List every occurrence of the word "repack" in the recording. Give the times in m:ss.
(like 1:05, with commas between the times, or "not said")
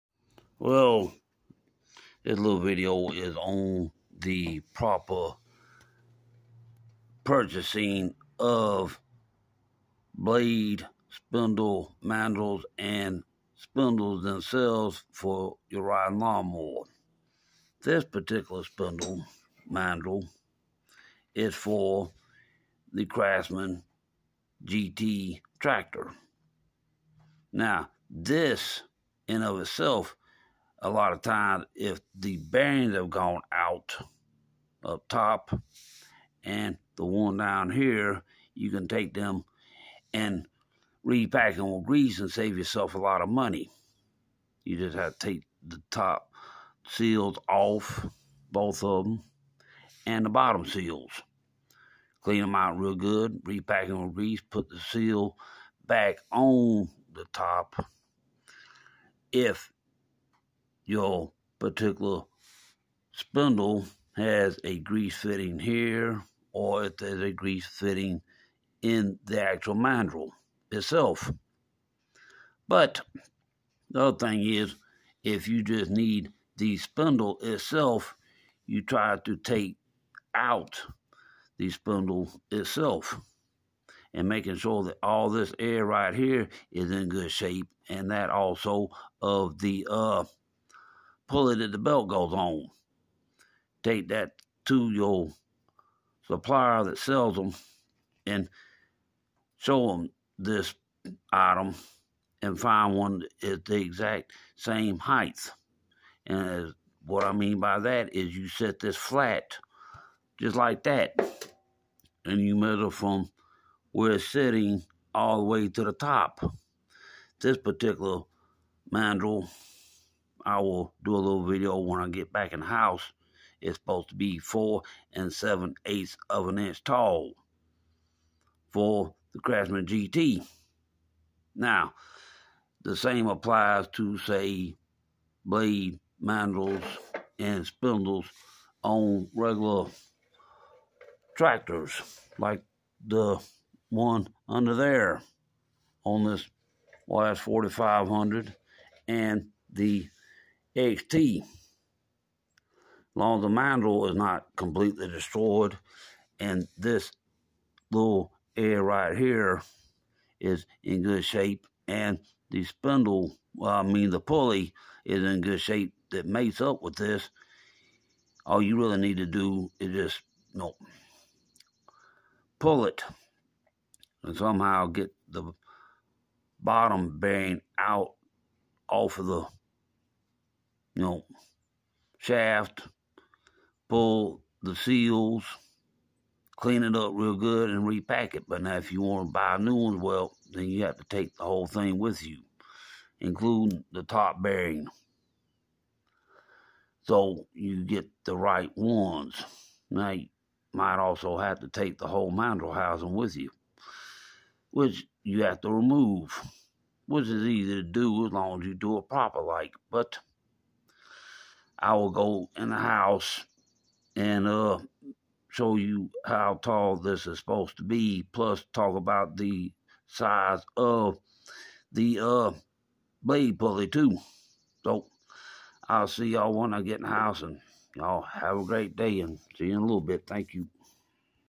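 0:41, 0:53, 3:07.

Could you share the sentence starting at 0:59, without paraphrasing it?
If your particular spindle has a grease fitting here or if there's a grease fitting in the actual mandrel itself.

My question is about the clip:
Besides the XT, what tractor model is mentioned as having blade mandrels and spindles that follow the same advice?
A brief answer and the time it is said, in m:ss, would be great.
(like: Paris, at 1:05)
YS4500, at 2:27.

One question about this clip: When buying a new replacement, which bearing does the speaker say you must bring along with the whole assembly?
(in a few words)
top bearing.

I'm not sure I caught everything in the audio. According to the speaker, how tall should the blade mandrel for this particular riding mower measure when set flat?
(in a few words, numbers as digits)
4 7/8 inches.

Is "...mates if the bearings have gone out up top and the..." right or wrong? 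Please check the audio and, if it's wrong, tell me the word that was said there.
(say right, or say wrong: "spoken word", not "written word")
wrong: "times", not "mates".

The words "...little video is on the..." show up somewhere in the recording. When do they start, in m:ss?
0:02.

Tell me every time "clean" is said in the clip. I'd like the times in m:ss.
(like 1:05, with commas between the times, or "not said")
0:52, 3:06.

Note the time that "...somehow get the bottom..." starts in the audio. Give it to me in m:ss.
2:54.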